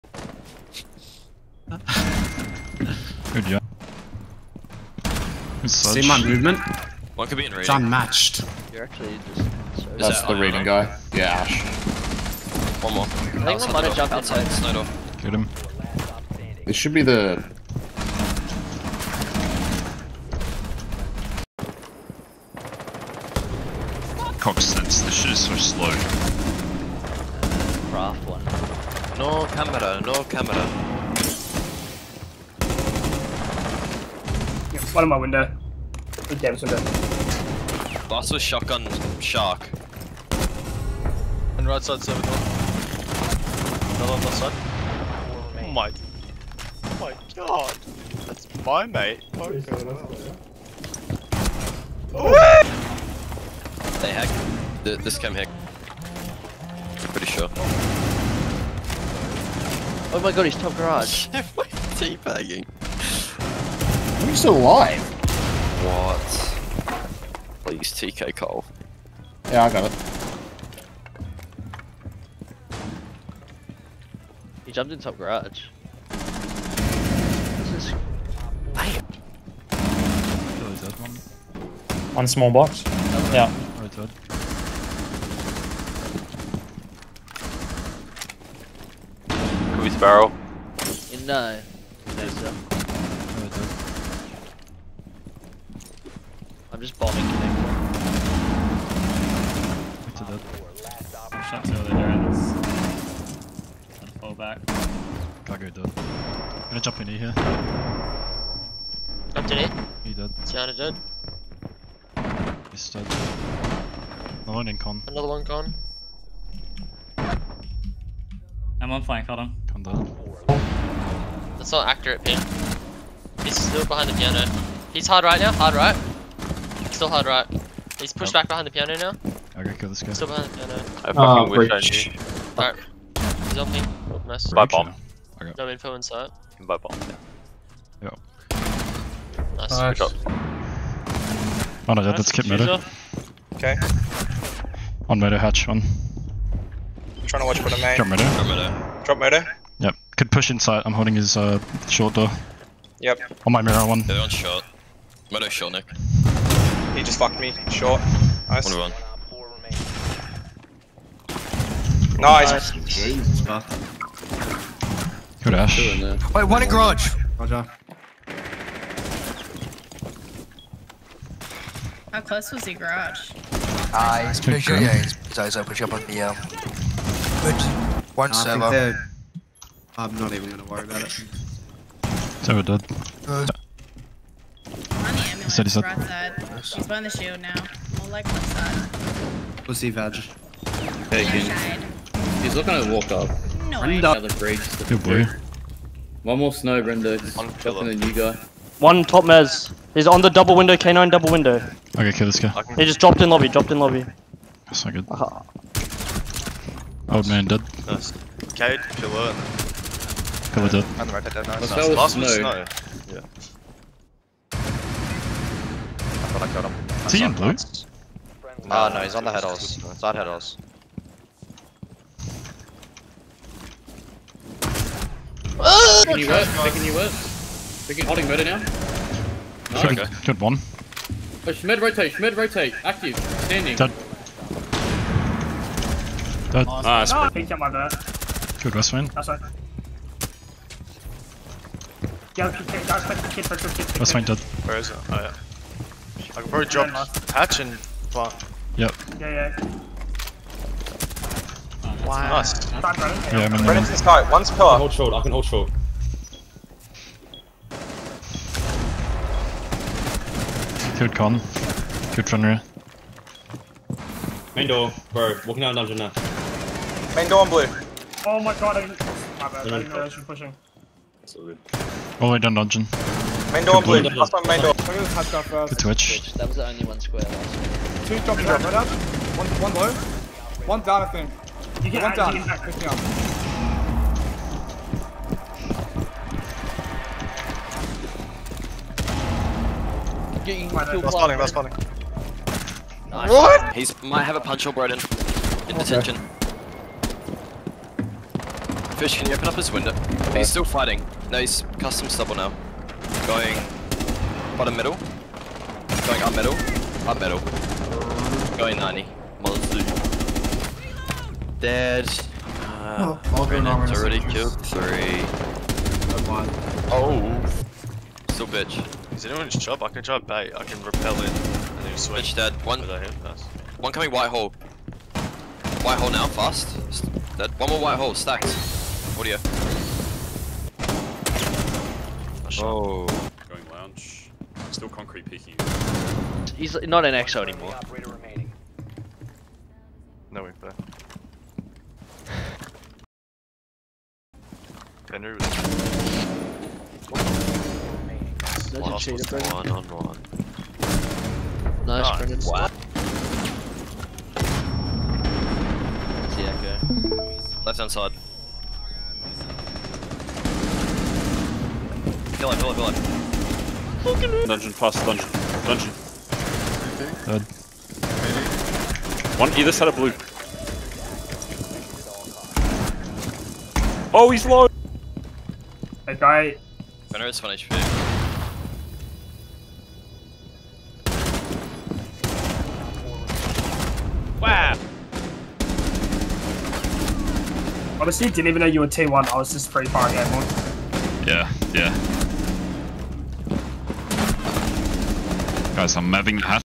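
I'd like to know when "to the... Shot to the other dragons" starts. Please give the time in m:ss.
1:40.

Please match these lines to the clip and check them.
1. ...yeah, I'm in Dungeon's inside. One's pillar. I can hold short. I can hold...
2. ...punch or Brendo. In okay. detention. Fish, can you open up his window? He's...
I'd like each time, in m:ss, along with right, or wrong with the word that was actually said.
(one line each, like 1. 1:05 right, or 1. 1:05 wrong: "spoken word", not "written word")
1. 4:13 wrong: "Brennan", not "Dungeon"
2. 4:54 wrong: "Broden", not "Brendo".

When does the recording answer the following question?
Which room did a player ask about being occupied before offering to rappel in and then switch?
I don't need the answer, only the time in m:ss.
5:19.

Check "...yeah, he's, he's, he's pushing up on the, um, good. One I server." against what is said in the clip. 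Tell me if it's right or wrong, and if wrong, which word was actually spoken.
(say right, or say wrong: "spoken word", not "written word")
right.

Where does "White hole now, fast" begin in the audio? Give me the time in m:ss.
5:25.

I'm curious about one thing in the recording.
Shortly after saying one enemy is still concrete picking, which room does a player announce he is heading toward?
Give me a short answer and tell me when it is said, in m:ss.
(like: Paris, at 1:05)
lounge, at 5:33.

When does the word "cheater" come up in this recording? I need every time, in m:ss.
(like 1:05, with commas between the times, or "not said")
5:49.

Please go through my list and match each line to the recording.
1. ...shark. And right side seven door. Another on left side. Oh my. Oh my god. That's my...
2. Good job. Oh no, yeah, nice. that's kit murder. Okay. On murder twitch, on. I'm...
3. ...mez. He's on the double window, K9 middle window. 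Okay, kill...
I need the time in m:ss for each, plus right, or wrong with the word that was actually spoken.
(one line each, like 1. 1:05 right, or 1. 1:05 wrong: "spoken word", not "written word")
1. 0:39 right
2. 2:19 wrong: "hatch", not "twitch"
3. 3:19 wrong: "double", not "middle".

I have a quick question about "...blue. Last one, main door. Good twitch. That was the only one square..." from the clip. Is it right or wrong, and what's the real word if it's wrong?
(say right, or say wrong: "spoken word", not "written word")
right.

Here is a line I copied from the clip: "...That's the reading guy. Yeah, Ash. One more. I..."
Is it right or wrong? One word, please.
right.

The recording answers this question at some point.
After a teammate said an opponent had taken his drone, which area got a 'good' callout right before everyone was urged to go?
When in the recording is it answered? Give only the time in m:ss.
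3:58.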